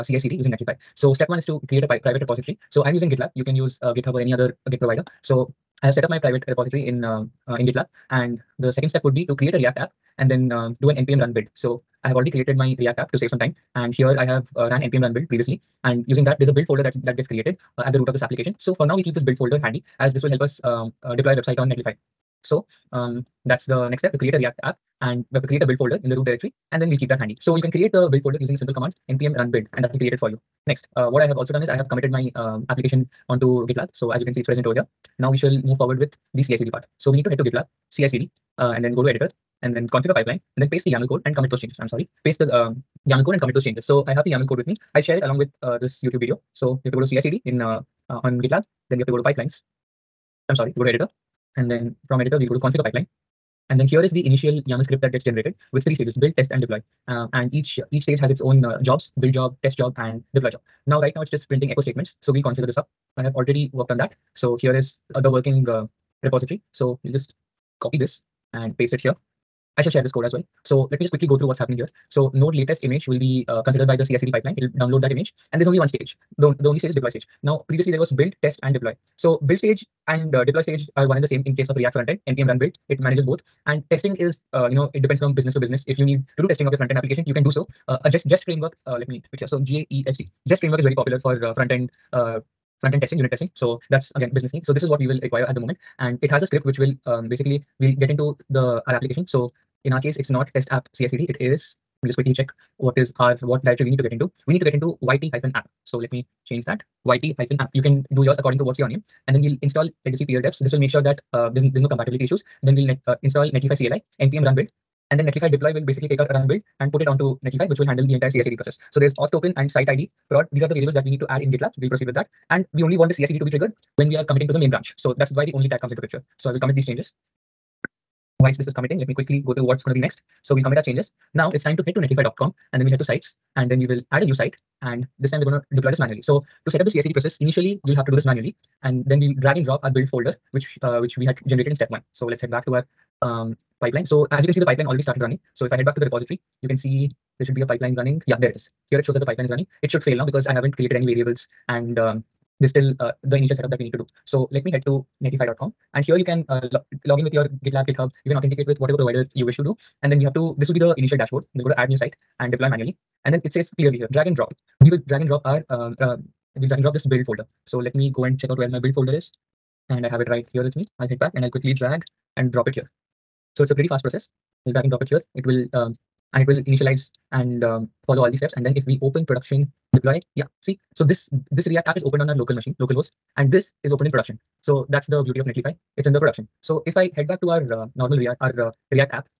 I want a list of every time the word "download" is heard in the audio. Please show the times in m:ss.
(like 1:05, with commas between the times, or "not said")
1:14.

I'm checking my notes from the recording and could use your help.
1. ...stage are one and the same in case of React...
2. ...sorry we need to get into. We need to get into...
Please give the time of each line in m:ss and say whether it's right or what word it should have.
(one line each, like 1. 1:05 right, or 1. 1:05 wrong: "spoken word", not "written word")
1. 1:20 right
2. 1:43 wrong: "directory", not "sorry".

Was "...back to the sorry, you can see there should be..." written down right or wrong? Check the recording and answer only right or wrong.
wrong.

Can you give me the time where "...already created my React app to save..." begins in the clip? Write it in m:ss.
0:12.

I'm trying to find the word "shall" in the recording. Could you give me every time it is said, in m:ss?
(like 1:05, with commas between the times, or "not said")
0:35, 1:09.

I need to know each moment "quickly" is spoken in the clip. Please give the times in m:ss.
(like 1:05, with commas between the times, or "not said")
1:11, 1:42, 2:09, 2:51.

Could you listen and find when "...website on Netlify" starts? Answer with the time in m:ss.
0:21.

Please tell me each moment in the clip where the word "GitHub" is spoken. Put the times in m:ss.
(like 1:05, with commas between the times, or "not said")
0:03, 2:37.